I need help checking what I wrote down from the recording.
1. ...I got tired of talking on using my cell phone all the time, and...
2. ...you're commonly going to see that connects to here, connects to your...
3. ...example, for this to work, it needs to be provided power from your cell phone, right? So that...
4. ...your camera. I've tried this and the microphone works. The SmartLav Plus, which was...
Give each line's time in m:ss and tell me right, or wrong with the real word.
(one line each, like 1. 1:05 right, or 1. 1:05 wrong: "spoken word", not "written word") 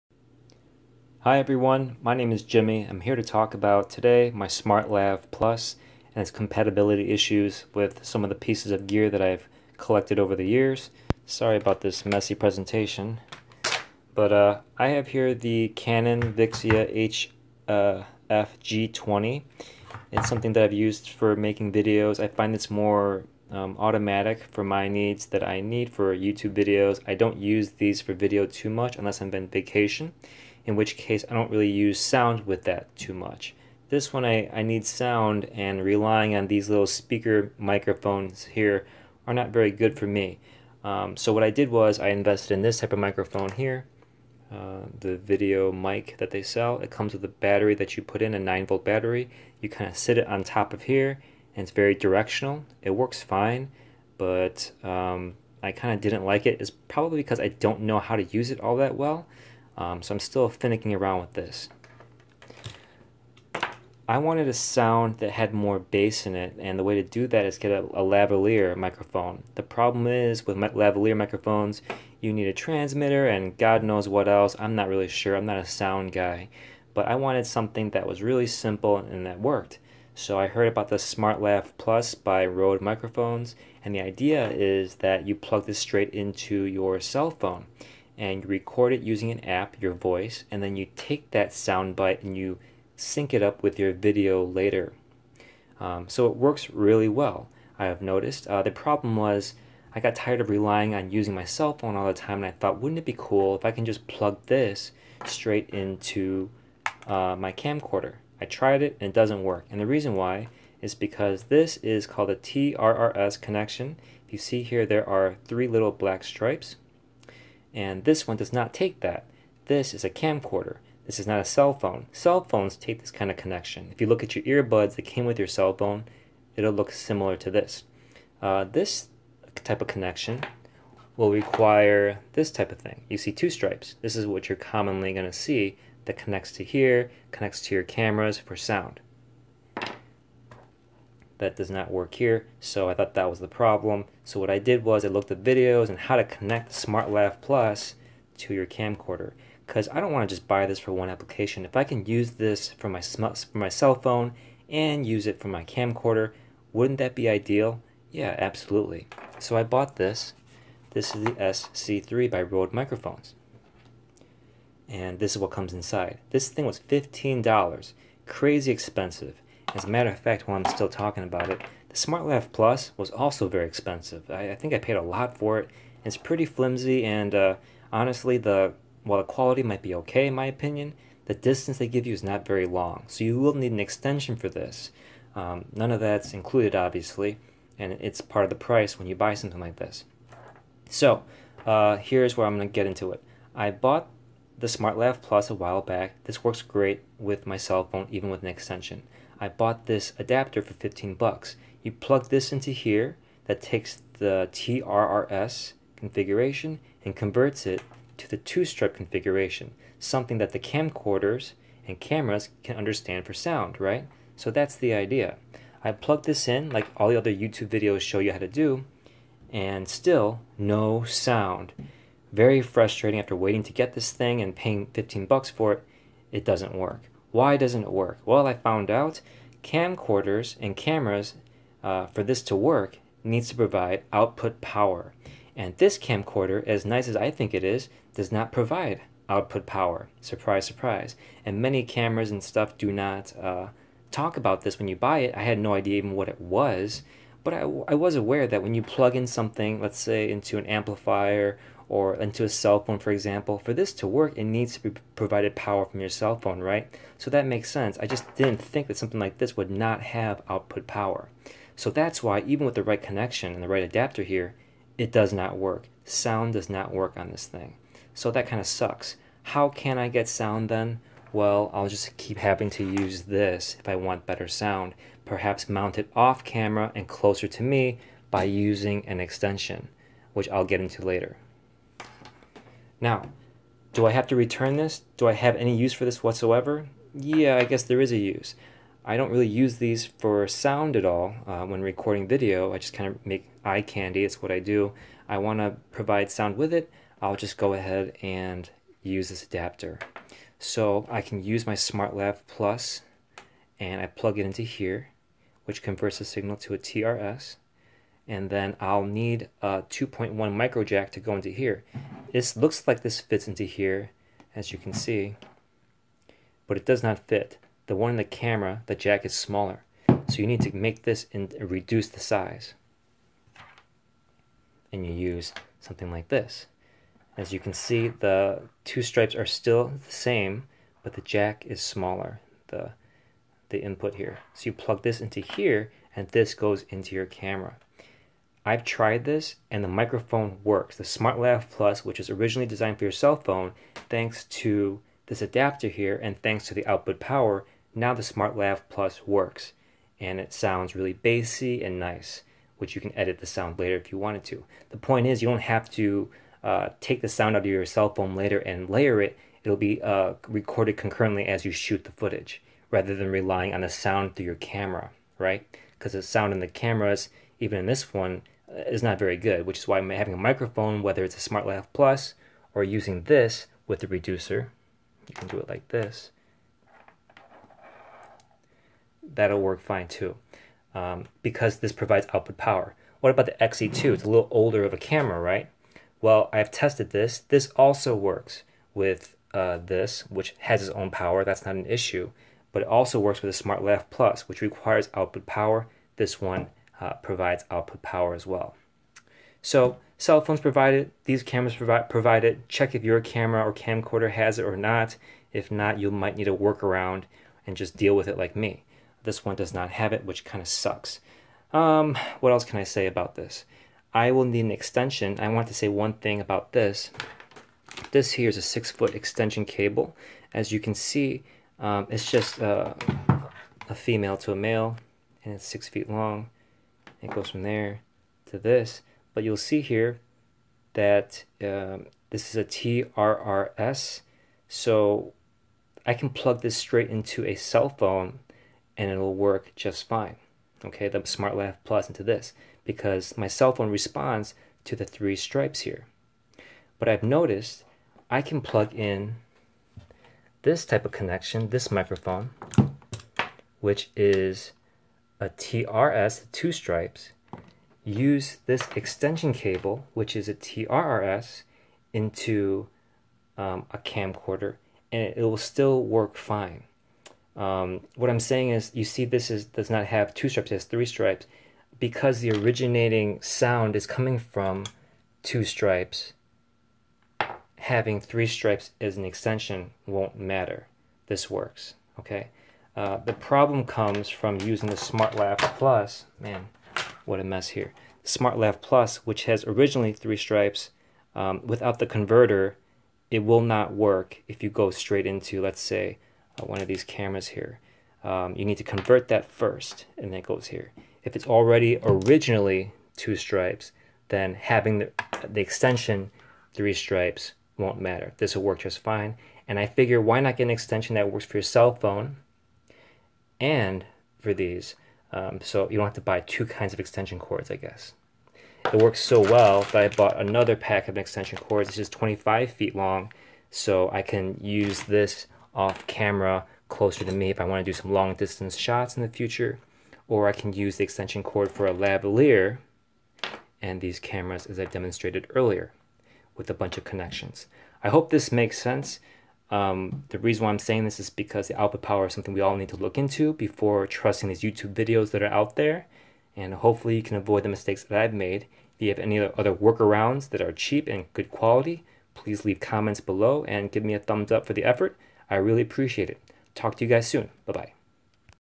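1. 1:39 wrong: "relying", not "talking"
2. 2:14 right
3. 4:13 right
4. 5:37 right.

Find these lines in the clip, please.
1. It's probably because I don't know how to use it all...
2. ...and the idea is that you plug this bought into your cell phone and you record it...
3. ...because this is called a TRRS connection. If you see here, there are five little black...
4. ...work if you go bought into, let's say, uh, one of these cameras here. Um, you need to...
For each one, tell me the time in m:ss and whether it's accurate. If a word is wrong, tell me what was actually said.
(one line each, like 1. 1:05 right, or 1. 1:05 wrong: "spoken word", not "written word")
1. 0:56 right
2. 1:23 wrong: "straight", not "bought"
3. 1:50 wrong: "three", not "five"
4. 8:13 wrong: "straight", not "bought".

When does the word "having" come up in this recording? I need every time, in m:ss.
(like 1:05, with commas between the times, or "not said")
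4:32, 6:10, 7:57, 8:24.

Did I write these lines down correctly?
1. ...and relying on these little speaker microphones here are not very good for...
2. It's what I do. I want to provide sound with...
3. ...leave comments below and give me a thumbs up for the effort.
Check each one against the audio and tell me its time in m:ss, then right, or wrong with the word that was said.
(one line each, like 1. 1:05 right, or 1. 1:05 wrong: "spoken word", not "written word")
1. 0:35 right
2. 4:54 right
3. 9:12 right.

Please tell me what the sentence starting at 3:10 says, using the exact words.
So, uh, here's where I'm going to get into it.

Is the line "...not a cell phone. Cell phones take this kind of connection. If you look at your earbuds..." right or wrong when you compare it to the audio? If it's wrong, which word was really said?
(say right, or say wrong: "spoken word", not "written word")
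right.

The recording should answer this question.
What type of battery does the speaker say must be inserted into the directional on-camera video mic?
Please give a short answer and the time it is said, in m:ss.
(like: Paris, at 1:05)
9 volt, at 0:48.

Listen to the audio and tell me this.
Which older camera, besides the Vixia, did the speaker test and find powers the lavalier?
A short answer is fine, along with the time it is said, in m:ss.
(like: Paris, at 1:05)
XE2, at 6:23.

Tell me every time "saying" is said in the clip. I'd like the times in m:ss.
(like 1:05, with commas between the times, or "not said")
7:48, 9:00.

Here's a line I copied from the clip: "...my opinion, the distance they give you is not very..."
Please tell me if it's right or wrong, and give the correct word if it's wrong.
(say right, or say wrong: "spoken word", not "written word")
right.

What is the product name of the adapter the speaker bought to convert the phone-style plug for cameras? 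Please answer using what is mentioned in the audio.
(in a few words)
SC3.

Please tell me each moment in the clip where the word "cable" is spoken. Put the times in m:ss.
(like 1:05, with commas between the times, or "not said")
6:59, 7:39.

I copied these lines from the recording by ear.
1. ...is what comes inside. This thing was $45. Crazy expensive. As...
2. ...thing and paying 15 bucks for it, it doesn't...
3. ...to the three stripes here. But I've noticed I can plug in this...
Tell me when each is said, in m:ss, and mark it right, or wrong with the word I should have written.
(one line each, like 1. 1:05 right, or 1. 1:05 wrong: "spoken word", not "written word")
1. 2:45 wrong: "15", not "45"
2. 3:44 right
3. 7:24 right.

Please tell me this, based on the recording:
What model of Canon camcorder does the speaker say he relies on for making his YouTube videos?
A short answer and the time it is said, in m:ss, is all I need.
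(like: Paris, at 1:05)
Vixia HFG20, at 0:16.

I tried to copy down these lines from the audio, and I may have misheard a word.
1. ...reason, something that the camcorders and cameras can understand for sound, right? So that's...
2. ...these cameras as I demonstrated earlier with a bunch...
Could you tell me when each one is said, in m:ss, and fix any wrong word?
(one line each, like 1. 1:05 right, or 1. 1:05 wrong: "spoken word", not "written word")
1. 3:28 wrong: "configuration", not "reason"
2. 8:54 right.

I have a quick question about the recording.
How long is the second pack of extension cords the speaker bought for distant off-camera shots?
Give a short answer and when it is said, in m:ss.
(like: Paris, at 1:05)
25 feet, at 8:42.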